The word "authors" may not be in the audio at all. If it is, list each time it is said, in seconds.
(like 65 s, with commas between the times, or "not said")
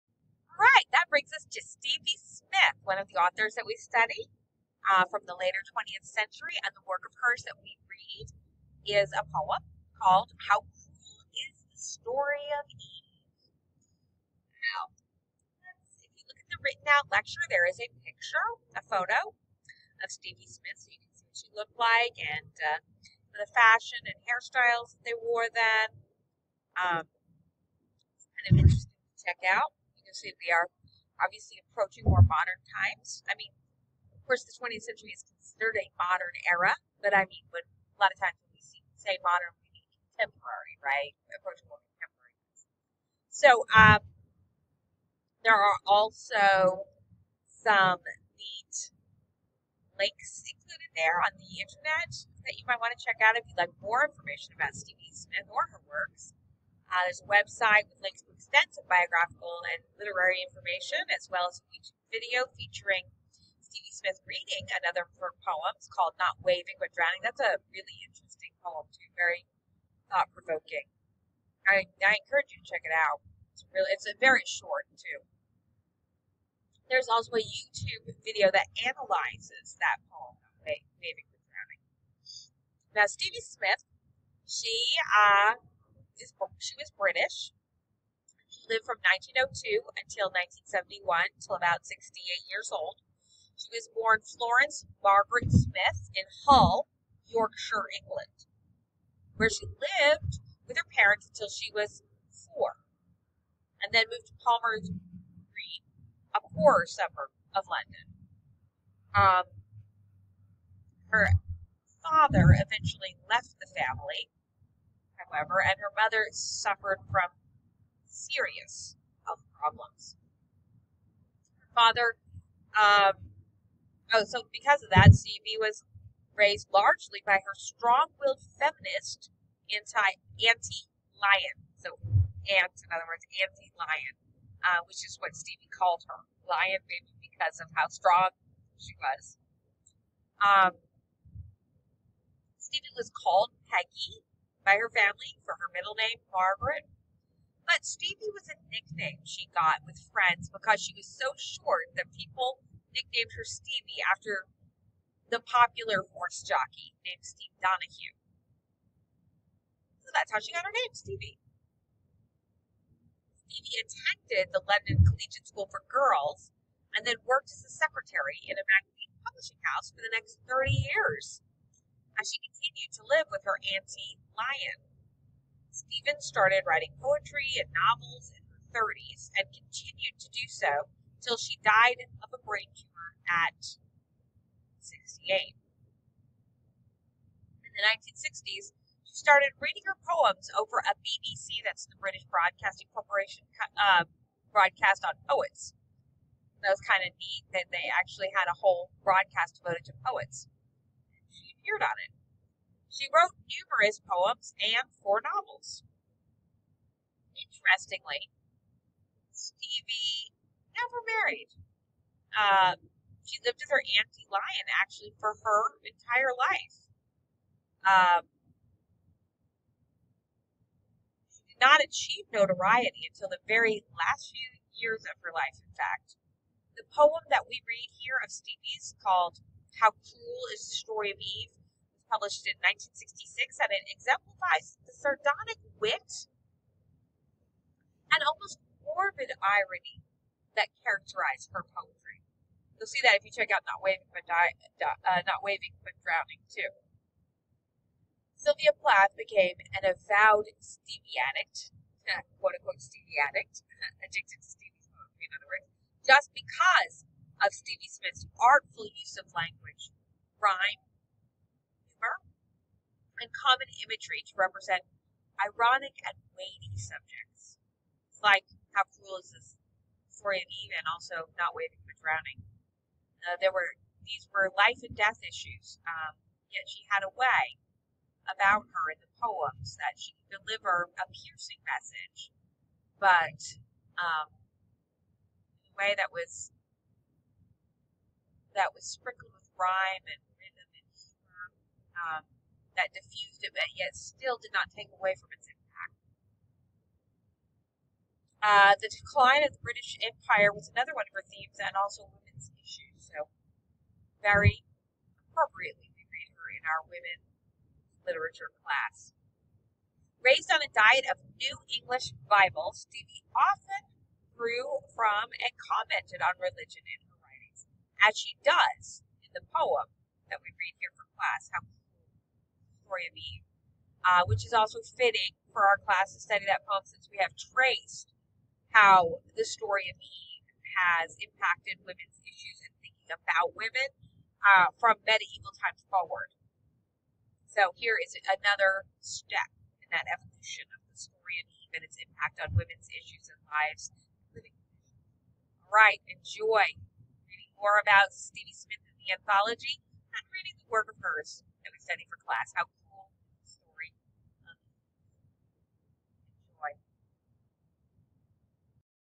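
3 s.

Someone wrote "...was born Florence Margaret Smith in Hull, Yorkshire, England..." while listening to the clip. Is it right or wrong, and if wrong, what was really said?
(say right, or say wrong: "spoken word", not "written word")
right.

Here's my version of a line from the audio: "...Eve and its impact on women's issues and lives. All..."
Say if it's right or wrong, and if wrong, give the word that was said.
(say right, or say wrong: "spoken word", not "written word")
right.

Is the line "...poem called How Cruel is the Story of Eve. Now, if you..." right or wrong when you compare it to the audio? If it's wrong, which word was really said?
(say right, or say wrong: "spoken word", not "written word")
right.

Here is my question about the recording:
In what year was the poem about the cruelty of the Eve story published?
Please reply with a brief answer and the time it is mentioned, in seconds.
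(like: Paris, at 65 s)
1966, at 232 s.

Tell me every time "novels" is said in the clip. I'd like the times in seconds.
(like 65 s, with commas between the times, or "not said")
177 s, 205 s.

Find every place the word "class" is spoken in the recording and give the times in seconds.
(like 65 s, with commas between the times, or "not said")
308 s, 321 s, 325 s, 352 s.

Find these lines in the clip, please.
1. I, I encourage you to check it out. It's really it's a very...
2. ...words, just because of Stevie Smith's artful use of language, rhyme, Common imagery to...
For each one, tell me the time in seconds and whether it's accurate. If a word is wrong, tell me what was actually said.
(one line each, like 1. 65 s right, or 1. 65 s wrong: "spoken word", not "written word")
1. 71 s right
2. 255 s right.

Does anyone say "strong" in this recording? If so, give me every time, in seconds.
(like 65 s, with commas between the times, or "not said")
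127 s, 137 s.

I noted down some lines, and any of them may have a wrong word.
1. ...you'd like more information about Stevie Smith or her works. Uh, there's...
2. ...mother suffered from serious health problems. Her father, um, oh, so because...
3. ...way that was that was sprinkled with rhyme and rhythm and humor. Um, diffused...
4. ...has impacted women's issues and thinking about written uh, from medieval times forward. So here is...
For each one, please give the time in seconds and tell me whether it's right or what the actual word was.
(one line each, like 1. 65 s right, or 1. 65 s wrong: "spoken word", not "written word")
1. 53 s right
2. 115 s right
3. 285 s right
4. 330 s wrong: "women", not "written".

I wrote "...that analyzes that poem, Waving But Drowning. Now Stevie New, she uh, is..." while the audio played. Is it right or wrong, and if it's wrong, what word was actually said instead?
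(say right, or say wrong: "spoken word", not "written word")
wrong: "Smith", not "New".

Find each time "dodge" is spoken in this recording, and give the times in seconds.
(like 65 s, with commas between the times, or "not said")
not said.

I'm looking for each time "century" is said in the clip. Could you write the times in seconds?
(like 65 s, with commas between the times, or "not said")
6 s, 34 s.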